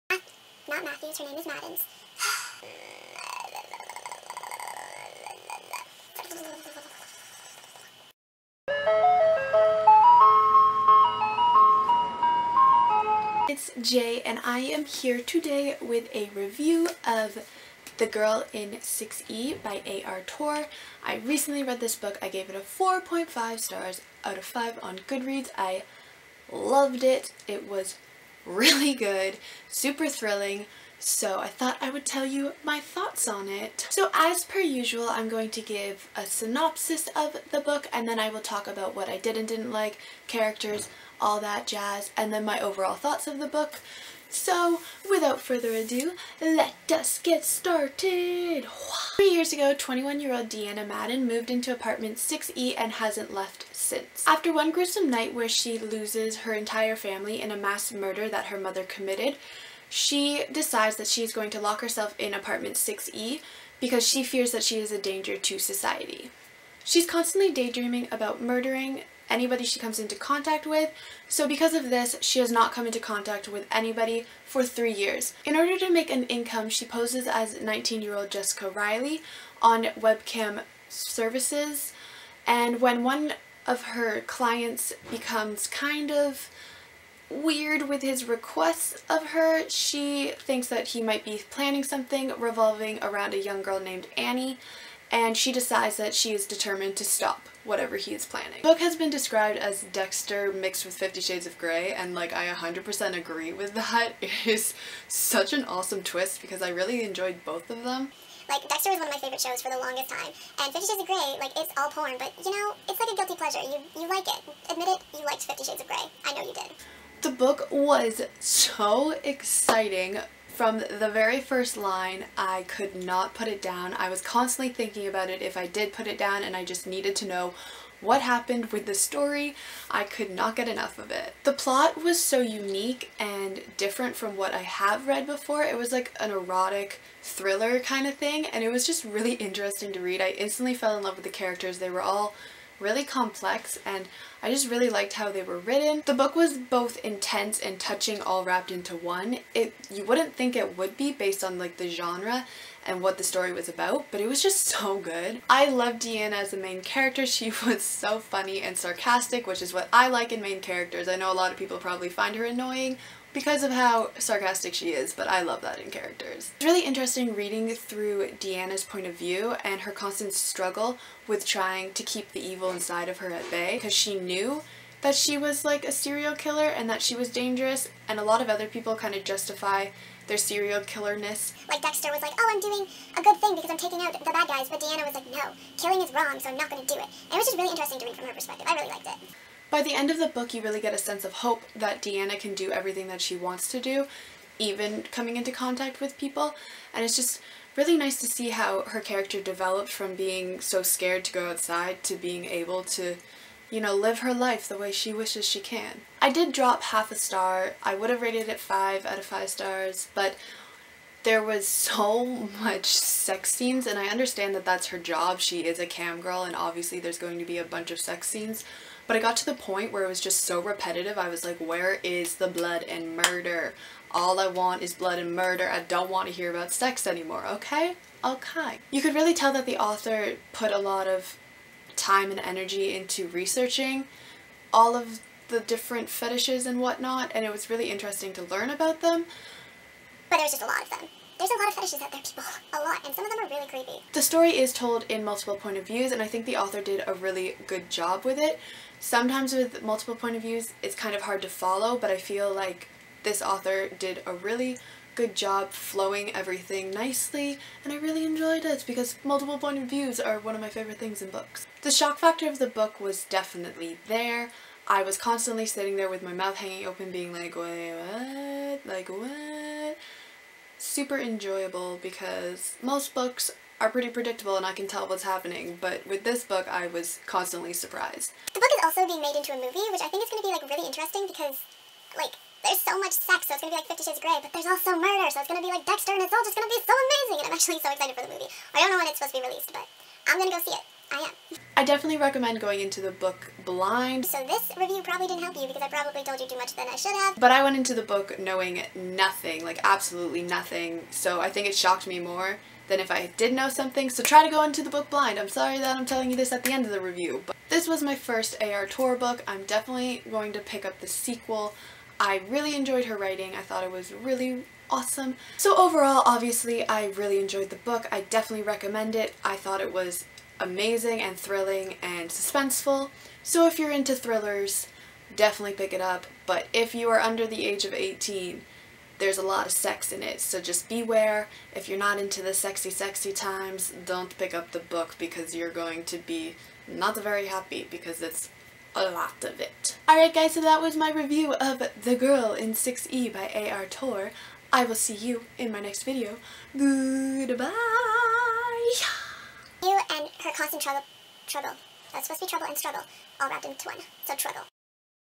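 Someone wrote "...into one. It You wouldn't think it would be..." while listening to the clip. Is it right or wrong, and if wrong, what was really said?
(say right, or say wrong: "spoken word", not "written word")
right.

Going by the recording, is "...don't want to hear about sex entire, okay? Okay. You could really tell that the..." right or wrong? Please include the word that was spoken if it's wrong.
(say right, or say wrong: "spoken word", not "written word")
wrong: "anymore", not "entire".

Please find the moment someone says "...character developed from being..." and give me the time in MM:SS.
03:18.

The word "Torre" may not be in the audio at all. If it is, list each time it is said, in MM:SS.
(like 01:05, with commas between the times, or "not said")
00:20, 05:08, 05:43.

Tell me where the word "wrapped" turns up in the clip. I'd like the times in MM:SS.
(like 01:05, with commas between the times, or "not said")
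02:28, 05:53.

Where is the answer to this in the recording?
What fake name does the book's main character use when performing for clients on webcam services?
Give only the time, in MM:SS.
01:18.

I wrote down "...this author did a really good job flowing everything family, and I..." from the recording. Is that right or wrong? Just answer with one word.
wrong.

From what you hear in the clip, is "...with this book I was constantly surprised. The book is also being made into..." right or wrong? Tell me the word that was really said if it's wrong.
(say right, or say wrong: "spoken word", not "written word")
right.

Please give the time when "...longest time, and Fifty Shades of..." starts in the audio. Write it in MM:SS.
01:49.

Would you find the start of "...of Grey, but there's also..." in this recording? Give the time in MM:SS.
04:44.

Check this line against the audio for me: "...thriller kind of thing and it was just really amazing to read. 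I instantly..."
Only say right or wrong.
wrong.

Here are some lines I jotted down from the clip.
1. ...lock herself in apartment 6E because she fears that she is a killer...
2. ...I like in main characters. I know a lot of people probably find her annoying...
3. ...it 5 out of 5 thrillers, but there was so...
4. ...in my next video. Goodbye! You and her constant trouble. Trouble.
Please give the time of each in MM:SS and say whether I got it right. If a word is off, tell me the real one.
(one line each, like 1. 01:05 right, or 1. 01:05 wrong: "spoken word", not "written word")
1. 01:01 wrong: "danger", not "killer"
2. 02:39 right
3. 03:28 wrong: "stars", not "thrillers"
4. 05:45 right.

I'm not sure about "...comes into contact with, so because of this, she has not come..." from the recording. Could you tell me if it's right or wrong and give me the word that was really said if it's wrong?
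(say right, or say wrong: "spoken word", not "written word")
right.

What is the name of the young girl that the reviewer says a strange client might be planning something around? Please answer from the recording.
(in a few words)
Annie.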